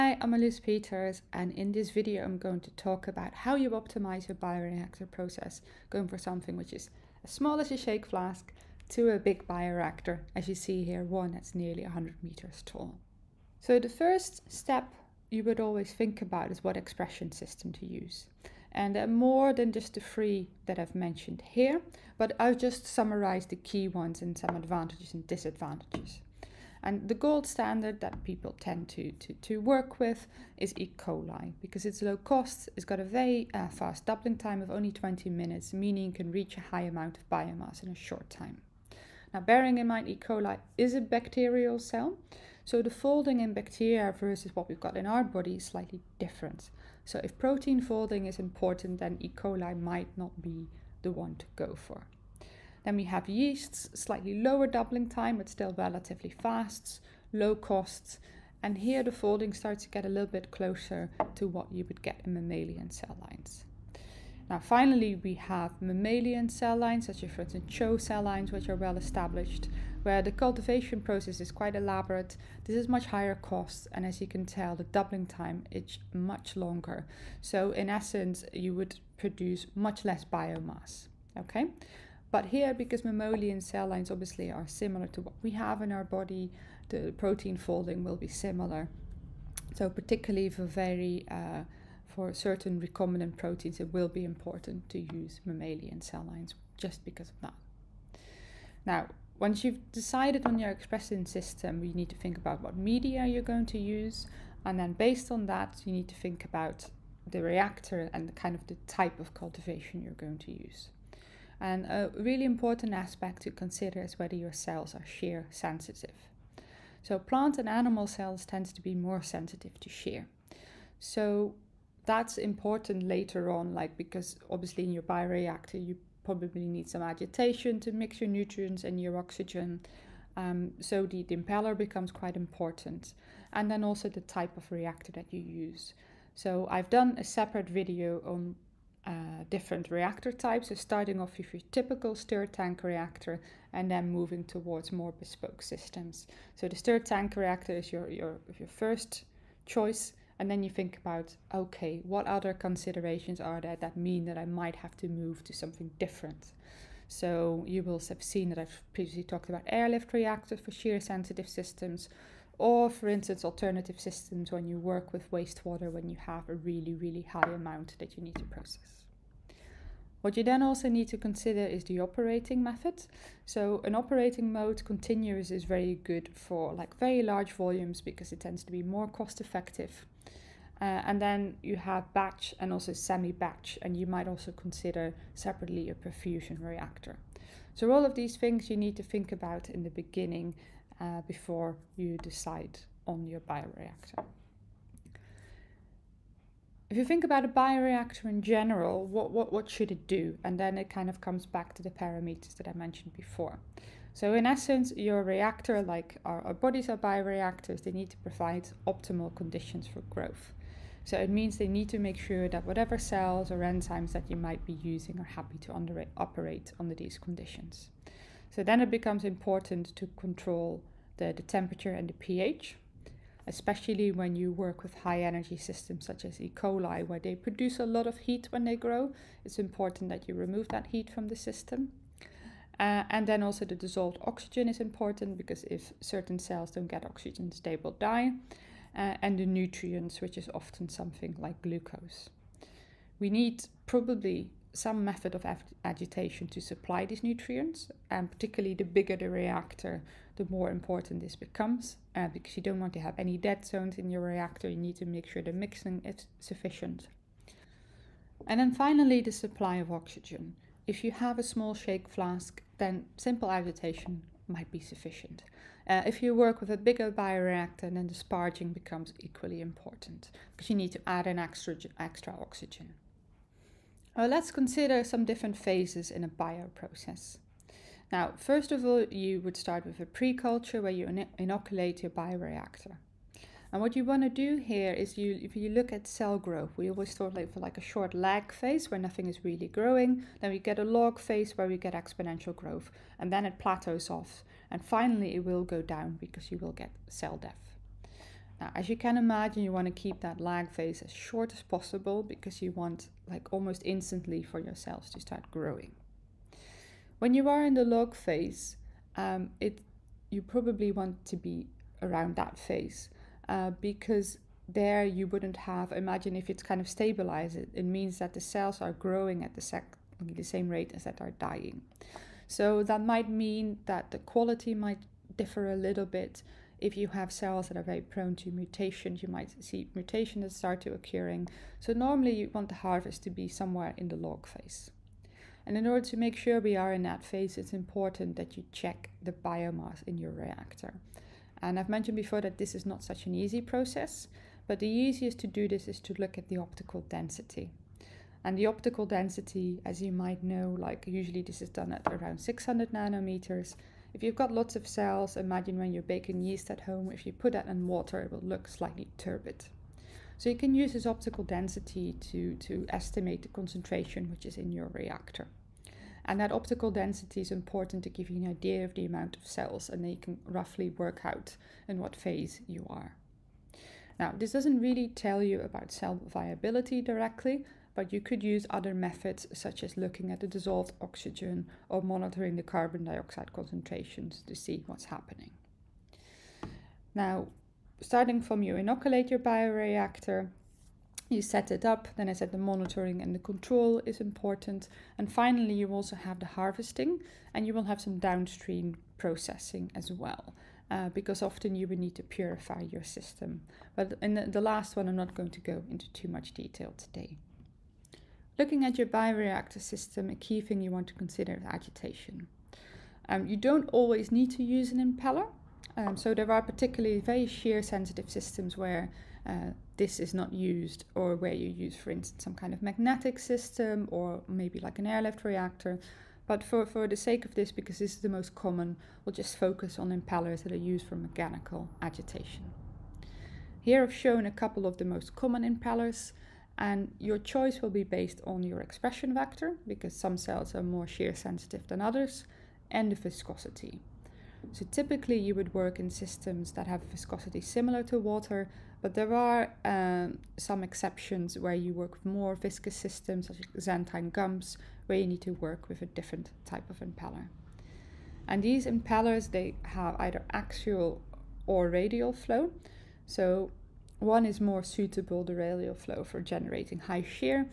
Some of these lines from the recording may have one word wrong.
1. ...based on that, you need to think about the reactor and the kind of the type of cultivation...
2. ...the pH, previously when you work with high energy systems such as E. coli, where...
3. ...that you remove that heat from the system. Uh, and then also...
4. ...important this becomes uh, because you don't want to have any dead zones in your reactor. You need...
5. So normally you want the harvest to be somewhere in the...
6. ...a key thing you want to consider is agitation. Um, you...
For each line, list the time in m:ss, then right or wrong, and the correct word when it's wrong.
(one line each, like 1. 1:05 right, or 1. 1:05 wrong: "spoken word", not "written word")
1. 1:44 right
2. 3:42 wrong: "especially", not "previously"
3. 3:50 right
4. 4:10 right
5. 5:31 right
6. 6:50 right.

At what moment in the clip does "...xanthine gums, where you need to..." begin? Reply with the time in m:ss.
7:33.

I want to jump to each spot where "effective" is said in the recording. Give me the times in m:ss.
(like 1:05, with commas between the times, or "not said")
2:59.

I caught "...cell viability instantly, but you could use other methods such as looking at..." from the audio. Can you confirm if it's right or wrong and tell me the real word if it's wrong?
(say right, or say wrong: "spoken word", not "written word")
wrong: "directly", not "instantly".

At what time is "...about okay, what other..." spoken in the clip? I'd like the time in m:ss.
2:30.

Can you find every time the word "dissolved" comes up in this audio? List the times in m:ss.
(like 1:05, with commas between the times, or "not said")
3:53, 6:20.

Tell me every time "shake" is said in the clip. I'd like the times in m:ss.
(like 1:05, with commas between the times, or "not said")
0:07, 4:21.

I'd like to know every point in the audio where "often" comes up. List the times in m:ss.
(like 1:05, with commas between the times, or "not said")
4:00, 6:41.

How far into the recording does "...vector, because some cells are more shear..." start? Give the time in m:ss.
7:19.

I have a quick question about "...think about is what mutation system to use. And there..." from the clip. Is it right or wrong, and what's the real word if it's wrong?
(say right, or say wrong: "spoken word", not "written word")
wrong: "expression", not "mutation".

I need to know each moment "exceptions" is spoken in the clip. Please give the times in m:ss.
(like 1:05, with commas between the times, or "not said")
7:30.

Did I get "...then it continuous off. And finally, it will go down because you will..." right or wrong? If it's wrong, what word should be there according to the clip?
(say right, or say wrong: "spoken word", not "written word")
wrong: "plateaus", not "continuous".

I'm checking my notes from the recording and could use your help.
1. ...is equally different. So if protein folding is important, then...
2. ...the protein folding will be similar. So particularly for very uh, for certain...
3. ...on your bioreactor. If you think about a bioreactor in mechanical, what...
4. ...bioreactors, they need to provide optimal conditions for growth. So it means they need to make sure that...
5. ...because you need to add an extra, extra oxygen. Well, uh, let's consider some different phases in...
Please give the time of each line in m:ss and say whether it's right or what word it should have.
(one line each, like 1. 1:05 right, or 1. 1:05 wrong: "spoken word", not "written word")
1. 0:45 wrong: "slightly", not "equally"
2. 1:26 right
3. 3:13 wrong: "general", not "mechanical"
4. 3:26 right
5. 4:30 right.